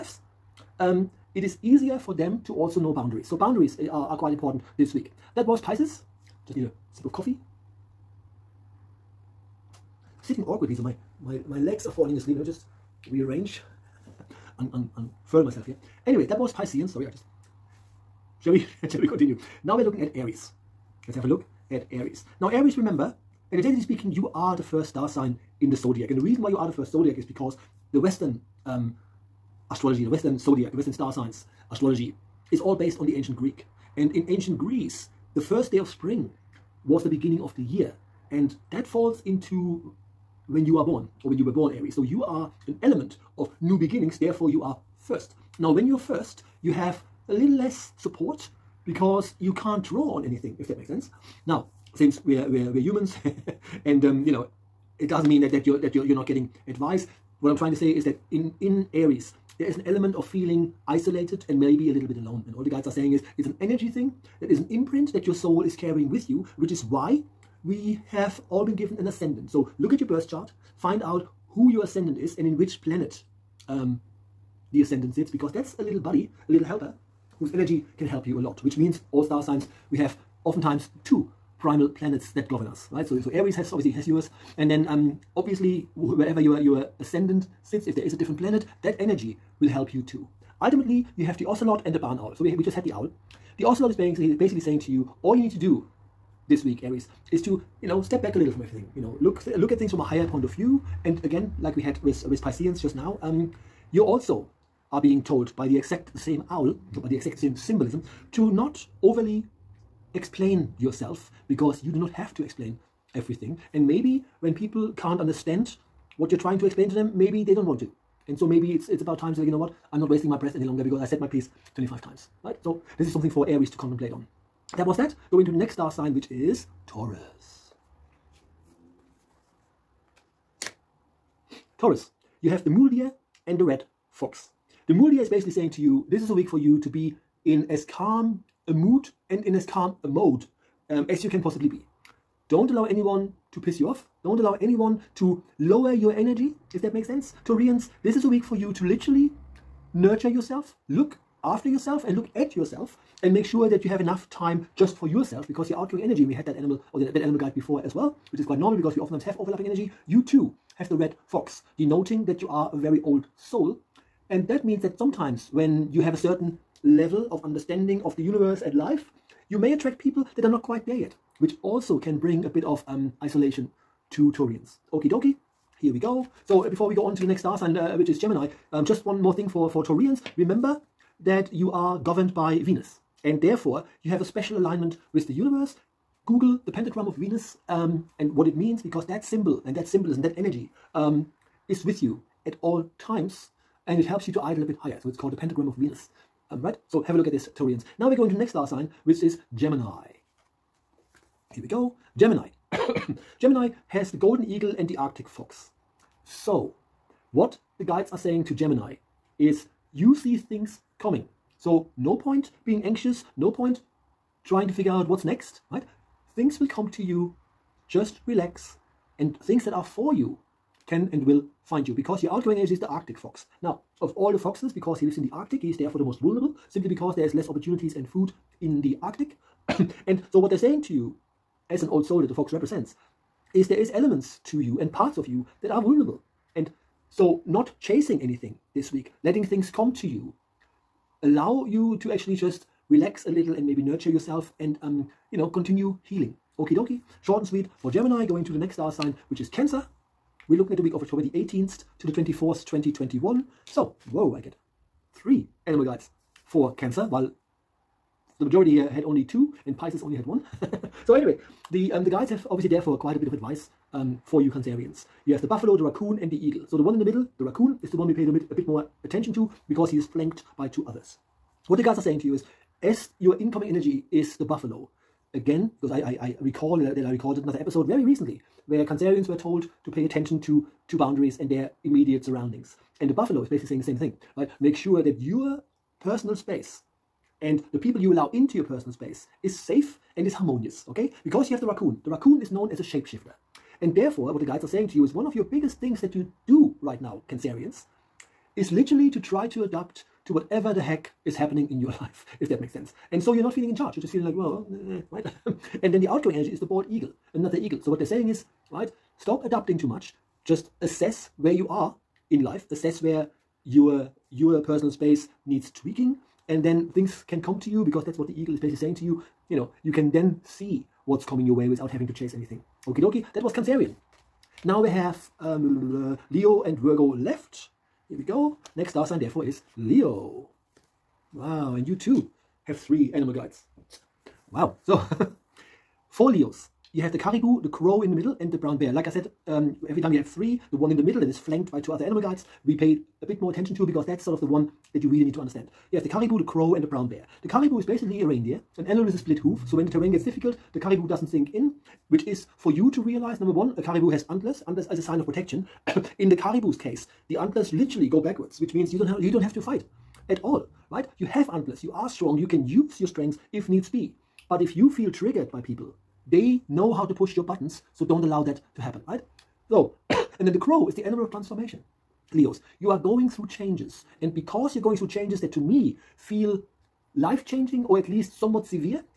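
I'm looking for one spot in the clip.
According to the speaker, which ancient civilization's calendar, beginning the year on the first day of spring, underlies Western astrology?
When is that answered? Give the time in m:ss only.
0:34.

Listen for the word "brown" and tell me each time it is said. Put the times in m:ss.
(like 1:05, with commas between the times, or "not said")
5:38, 5:46.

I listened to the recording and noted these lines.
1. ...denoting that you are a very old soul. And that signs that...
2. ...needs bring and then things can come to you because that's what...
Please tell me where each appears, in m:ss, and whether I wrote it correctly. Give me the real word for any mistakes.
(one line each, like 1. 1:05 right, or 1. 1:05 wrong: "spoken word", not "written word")
1. 2:41 wrong: "means", not "signs"
2. 5:15 wrong: "tweaking", not "bring".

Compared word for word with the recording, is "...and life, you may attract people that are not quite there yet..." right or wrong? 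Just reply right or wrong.
right.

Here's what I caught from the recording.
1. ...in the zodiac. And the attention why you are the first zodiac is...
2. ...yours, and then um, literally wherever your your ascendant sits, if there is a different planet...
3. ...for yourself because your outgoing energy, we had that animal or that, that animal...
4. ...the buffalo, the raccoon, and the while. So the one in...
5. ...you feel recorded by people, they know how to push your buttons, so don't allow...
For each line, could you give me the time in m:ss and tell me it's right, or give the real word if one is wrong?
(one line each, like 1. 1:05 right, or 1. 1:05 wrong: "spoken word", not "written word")
1. 0:25 wrong: "reason", not "attention"
2. 1:24 wrong: "obviously", not "literally"
3. 2:34 right
4. 4:25 wrong: "eagle", not "while"
5. 6:04 wrong: "triggered", not "recorded".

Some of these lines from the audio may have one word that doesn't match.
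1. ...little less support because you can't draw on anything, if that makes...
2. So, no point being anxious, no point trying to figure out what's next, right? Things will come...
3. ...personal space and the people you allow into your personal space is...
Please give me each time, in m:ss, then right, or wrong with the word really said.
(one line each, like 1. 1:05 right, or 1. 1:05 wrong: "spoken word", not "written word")
1. 0:47 right
2. 3:31 right
3. 4:46 right.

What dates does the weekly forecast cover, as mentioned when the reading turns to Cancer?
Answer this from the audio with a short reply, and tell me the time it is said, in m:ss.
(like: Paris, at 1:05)
October 18 to 24, 2021, at 4:11.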